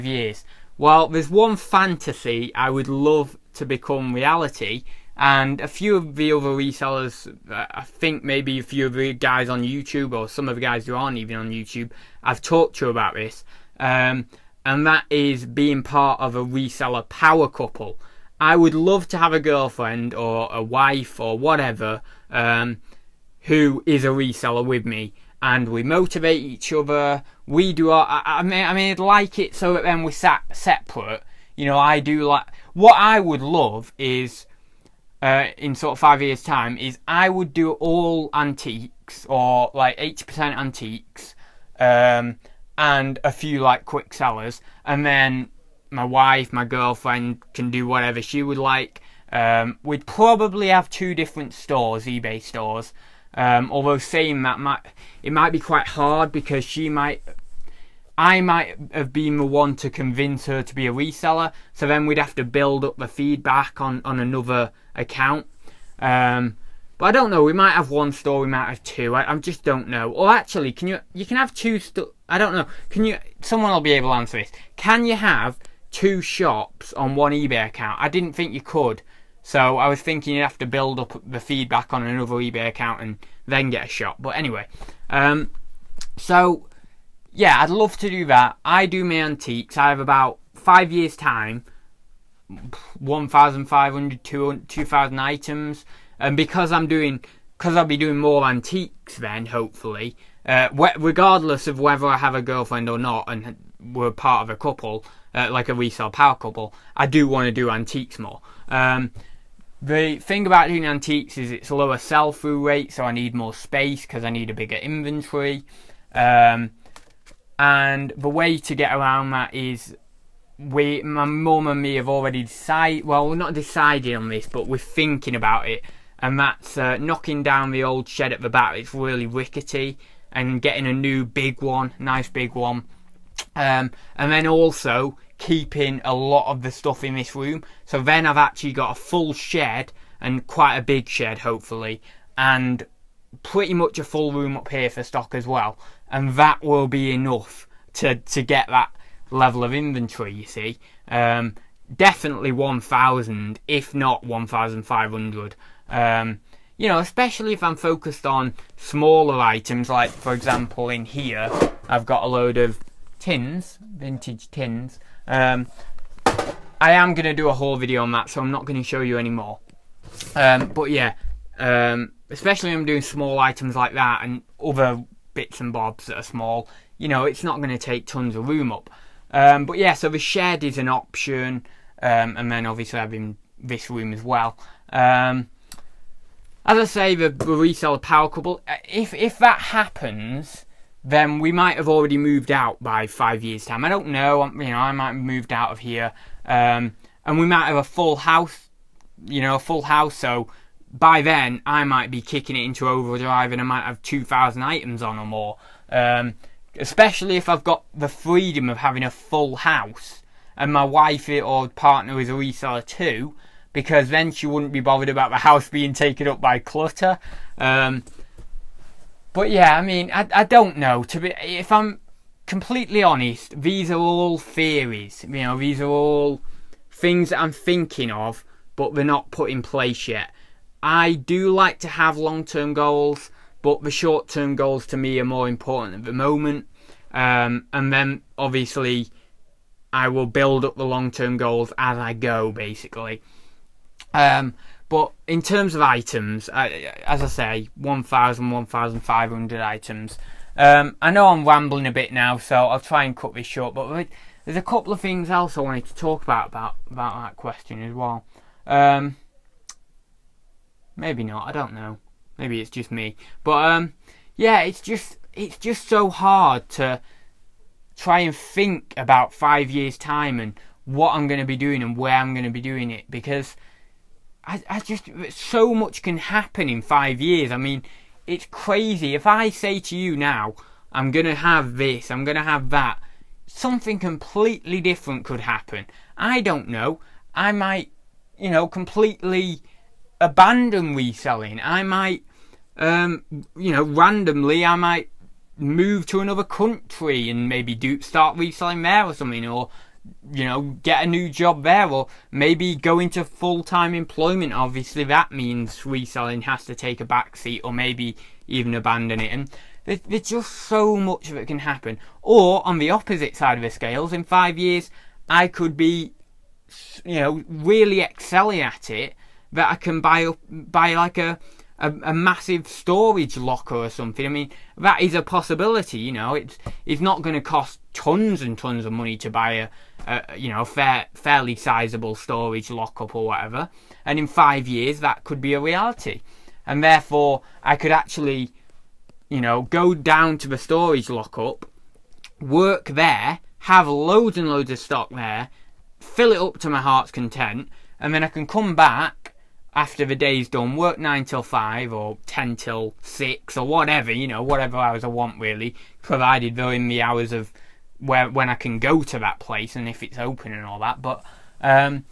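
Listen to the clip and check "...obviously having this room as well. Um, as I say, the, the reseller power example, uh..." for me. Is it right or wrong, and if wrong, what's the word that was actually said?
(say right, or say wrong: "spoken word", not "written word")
wrong: "couple", not "example".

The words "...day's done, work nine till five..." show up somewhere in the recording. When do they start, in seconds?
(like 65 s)
350 s.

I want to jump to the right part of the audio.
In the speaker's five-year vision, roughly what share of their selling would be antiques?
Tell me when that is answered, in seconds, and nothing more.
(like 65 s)
39 s.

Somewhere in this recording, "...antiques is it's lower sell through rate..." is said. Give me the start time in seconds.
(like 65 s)
110 s.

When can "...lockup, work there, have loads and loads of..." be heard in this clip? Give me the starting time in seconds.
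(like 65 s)
341 s.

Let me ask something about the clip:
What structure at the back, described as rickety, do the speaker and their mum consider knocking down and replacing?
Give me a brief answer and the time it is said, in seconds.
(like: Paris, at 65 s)
the old shed, at 127 s.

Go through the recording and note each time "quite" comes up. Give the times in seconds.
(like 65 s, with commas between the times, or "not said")
55 s, 140 s.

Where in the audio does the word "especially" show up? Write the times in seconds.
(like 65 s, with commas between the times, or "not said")
156 s, 172 s, 206 s.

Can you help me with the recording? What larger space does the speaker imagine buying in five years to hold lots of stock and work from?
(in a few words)
storage locker.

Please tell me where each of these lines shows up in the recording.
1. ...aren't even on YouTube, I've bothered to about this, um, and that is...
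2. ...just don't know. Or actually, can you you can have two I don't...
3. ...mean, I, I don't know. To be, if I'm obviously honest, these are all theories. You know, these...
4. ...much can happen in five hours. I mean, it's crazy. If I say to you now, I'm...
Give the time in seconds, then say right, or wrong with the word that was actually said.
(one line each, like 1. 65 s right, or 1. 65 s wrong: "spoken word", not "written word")
1. 10 s wrong: "talked", not "bothered"
2. 69 s right
3. 219 s wrong: "completely", not "obviously"
4. 275 s wrong: "years", not "hours".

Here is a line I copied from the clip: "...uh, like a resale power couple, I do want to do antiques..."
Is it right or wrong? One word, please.
right.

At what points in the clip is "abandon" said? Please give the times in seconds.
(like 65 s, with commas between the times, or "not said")
290 s, 308 s.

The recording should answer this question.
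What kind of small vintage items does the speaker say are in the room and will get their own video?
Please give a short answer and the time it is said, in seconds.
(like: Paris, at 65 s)
vintage tins, at 163 s.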